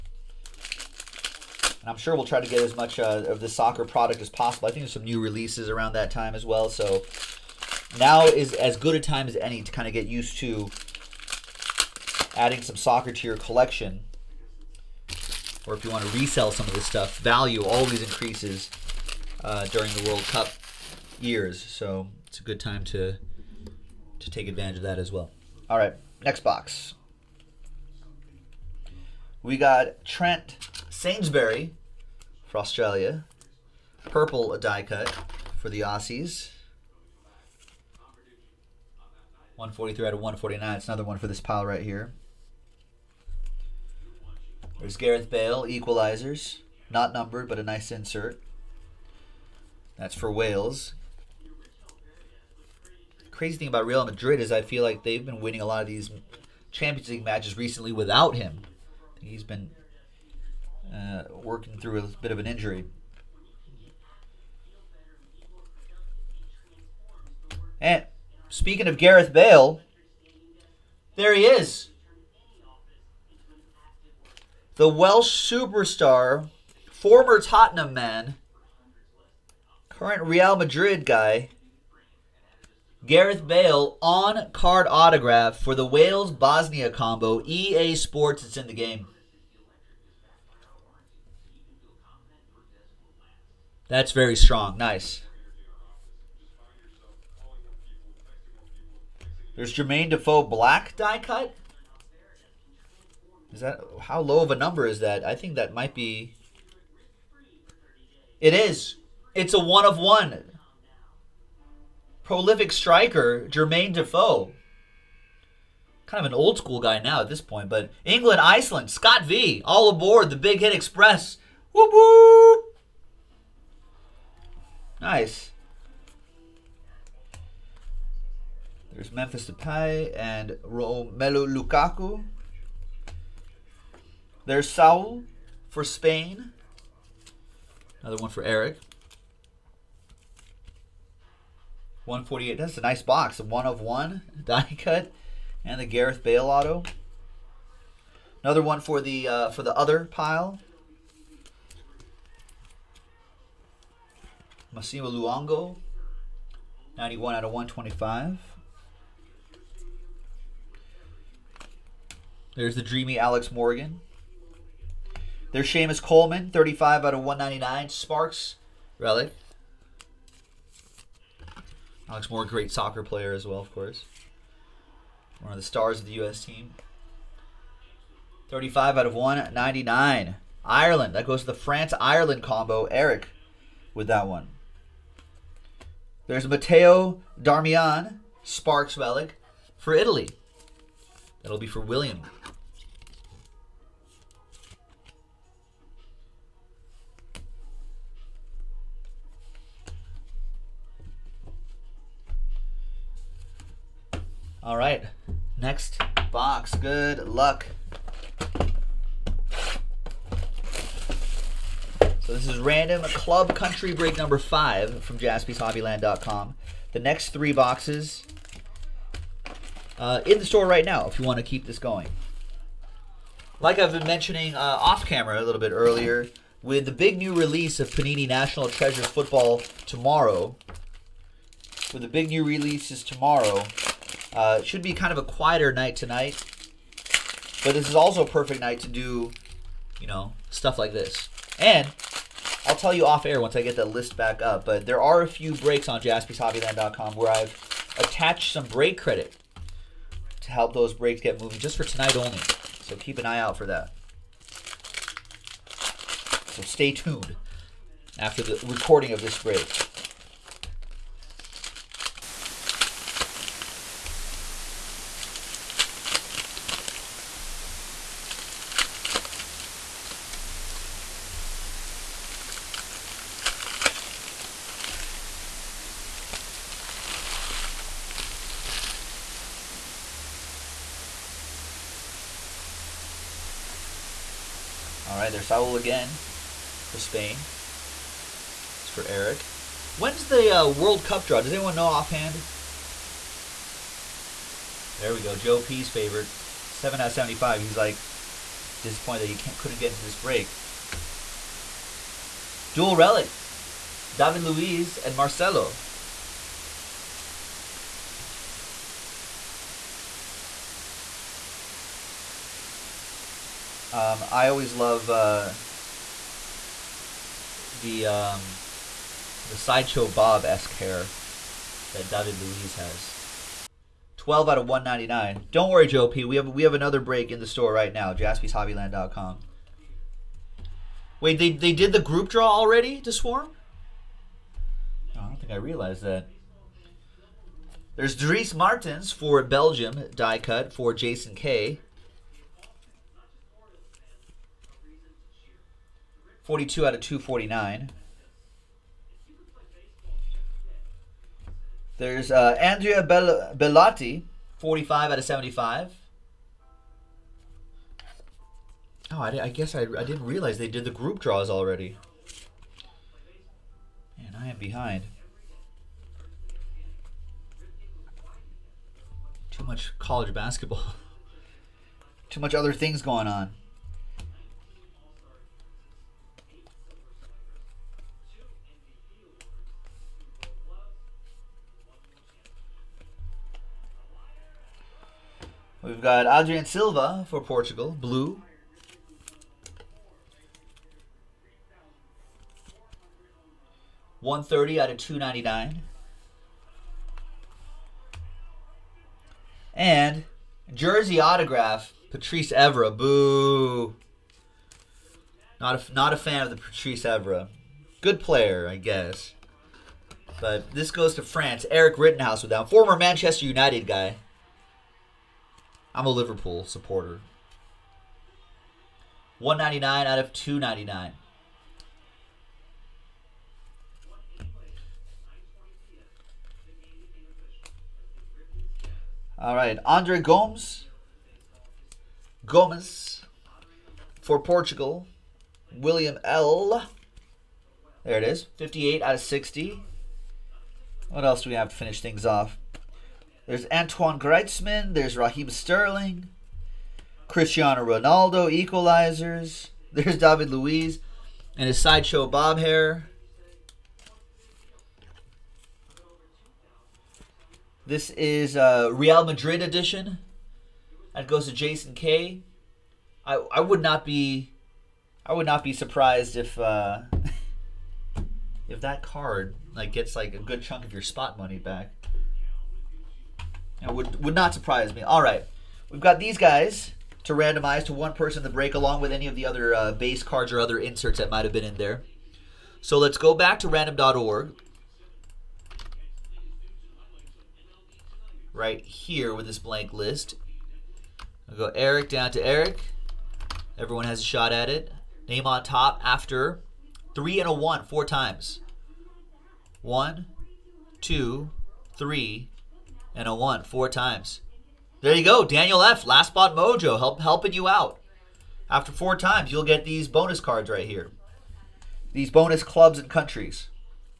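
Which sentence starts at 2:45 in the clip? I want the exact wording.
There's Seamus Coleman, 35 out of 199.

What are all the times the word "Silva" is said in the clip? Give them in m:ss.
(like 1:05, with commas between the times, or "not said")
6:26.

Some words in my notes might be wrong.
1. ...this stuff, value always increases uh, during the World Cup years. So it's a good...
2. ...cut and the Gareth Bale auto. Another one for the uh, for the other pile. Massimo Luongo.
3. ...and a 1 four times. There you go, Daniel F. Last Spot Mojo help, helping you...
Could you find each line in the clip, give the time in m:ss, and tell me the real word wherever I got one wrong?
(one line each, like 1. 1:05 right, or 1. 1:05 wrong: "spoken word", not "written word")
1. 0:16 right
2. 2:24 right
3. 8:23 right.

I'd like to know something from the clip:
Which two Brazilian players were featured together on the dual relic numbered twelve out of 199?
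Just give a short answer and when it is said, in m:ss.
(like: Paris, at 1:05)
David Luiz and Marcelo, at 5:04.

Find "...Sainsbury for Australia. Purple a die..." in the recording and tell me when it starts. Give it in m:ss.
0:30.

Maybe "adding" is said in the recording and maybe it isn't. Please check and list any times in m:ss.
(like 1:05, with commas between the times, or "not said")
0:12.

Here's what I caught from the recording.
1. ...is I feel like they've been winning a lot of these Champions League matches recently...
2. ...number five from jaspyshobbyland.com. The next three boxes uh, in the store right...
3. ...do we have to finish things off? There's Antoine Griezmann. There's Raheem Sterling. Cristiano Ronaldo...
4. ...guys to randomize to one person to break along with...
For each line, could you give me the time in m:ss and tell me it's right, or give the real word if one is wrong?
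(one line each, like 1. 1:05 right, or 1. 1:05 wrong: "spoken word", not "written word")
1. 0:54 right
2. 3:34 right
3. 7:21 right
4. 7:56 right.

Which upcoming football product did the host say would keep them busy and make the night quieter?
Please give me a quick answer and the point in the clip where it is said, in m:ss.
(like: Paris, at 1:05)
Panini National Treasures, at 3:47.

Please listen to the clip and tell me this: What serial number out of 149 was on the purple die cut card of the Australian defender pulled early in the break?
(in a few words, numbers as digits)
143.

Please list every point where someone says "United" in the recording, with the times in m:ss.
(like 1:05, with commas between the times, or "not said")
6:53.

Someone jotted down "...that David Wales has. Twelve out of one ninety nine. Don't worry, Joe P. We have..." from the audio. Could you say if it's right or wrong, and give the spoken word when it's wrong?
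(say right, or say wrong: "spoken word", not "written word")
wrong: "Luiz", not "Wales".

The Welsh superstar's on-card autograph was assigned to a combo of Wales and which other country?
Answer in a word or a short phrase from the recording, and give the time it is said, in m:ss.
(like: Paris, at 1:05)
Bosnia, at 1:26.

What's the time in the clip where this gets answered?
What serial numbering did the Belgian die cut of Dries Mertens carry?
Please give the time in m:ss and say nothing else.
5:46.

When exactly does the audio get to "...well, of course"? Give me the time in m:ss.
2:53.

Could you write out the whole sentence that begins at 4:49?
When's the uh, World Cup draw?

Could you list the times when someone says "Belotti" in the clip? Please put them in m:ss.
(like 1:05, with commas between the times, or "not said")
5:53.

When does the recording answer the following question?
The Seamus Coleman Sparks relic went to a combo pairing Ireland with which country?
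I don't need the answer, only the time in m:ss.
3:01.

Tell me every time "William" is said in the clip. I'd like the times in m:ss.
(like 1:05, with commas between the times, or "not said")
3:11, 7:15.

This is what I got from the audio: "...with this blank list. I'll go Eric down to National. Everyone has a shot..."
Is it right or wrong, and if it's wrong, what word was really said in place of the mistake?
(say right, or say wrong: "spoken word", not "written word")
wrong: "Eric", not "National".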